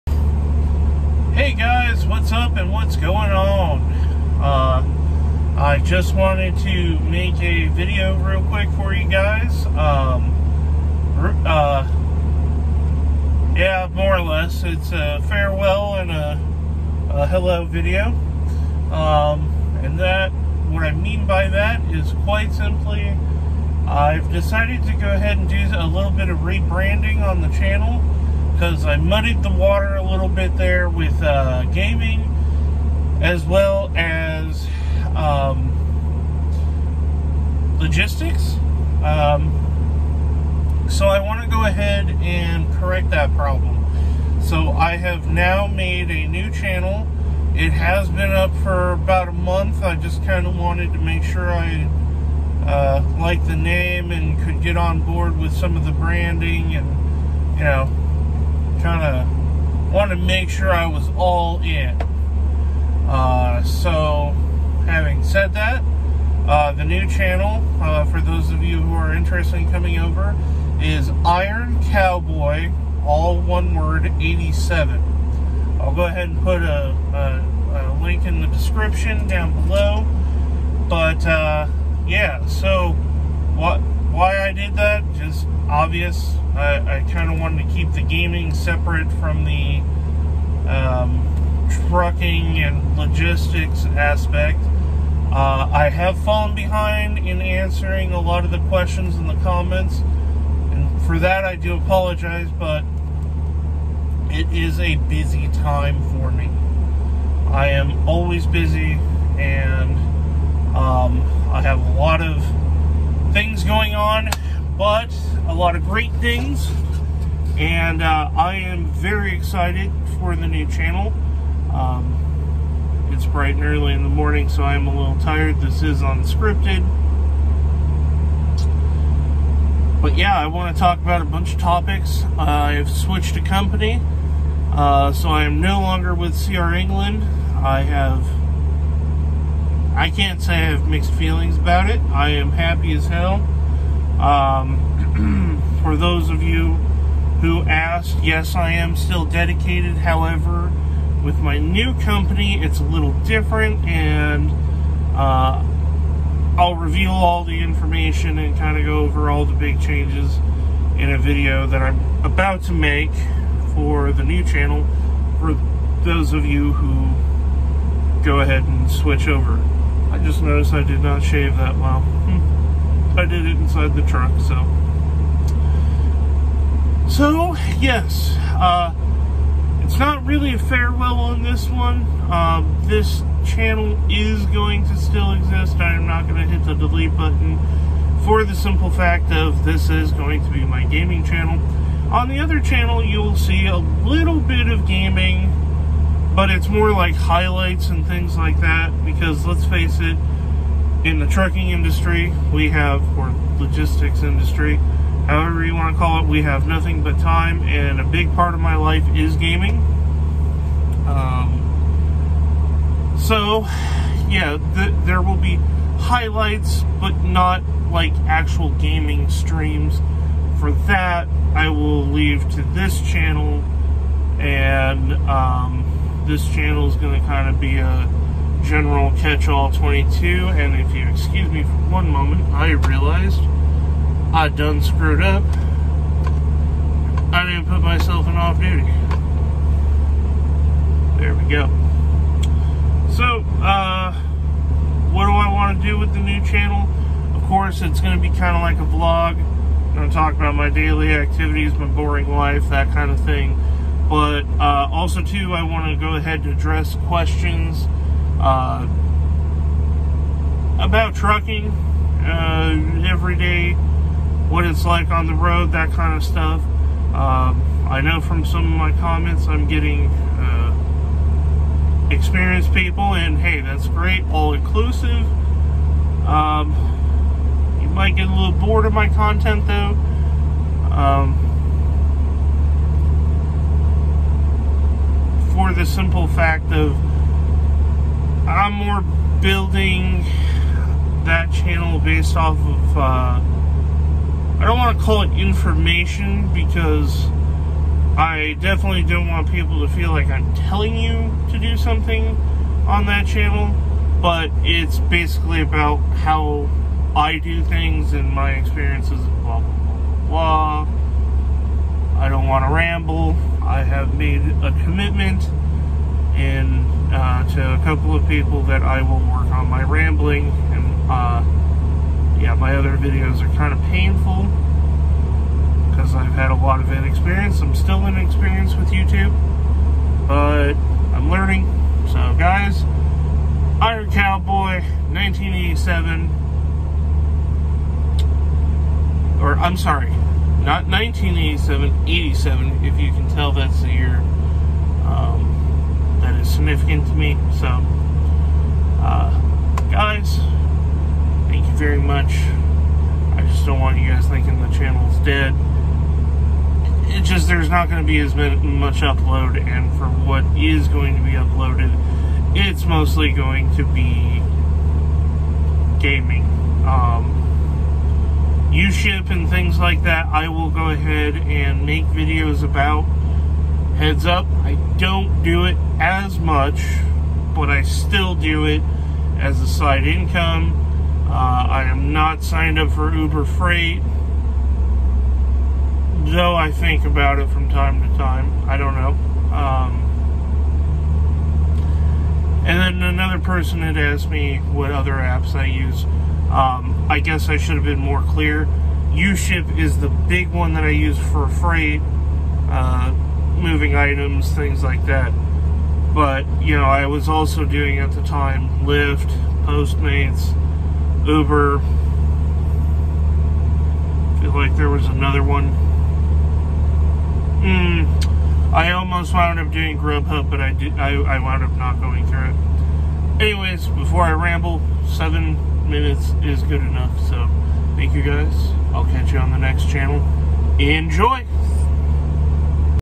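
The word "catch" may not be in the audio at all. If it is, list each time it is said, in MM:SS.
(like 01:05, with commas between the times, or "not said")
03:49, 07:09.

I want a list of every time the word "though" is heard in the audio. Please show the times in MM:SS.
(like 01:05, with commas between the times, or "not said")
04:39, 06:26.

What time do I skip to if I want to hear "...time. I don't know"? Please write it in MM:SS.
06:28.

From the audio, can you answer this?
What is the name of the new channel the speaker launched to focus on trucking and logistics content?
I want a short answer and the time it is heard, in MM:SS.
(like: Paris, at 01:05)
Iron Cowboy 87, at 01:11.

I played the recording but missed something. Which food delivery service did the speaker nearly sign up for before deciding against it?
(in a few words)
Grubhub.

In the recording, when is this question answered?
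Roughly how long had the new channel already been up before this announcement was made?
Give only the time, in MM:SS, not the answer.
00:48.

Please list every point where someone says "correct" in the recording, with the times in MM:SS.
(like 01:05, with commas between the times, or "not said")
00:42.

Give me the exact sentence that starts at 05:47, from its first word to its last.
So, uh, guys, thank you very much.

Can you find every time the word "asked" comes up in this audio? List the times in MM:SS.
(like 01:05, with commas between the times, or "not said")
02:27, 06:33.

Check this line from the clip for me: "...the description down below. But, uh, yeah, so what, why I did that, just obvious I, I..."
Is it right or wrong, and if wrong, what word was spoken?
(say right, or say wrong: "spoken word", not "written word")
right.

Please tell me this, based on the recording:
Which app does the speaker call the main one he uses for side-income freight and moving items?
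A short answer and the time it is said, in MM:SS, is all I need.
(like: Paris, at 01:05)
UShip, at 06:39.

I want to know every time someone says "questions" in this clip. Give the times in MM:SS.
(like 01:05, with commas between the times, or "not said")
01:38, 04:17.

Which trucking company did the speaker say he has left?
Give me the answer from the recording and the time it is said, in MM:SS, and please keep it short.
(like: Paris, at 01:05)
CR England, at 02:16.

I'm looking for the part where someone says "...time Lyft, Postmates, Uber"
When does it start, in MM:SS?
06:48.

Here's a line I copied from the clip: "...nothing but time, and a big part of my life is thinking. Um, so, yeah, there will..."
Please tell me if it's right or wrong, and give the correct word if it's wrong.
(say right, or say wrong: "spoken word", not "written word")
wrong: "gaming", not "thinking".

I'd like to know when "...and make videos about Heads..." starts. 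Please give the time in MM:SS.
06:11.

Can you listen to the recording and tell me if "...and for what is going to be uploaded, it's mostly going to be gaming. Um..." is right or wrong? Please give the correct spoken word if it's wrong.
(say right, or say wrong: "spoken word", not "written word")
right.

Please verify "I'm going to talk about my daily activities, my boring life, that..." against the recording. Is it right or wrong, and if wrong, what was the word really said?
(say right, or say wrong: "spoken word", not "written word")
right.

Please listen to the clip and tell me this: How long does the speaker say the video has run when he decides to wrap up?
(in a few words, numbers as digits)
7 minutes.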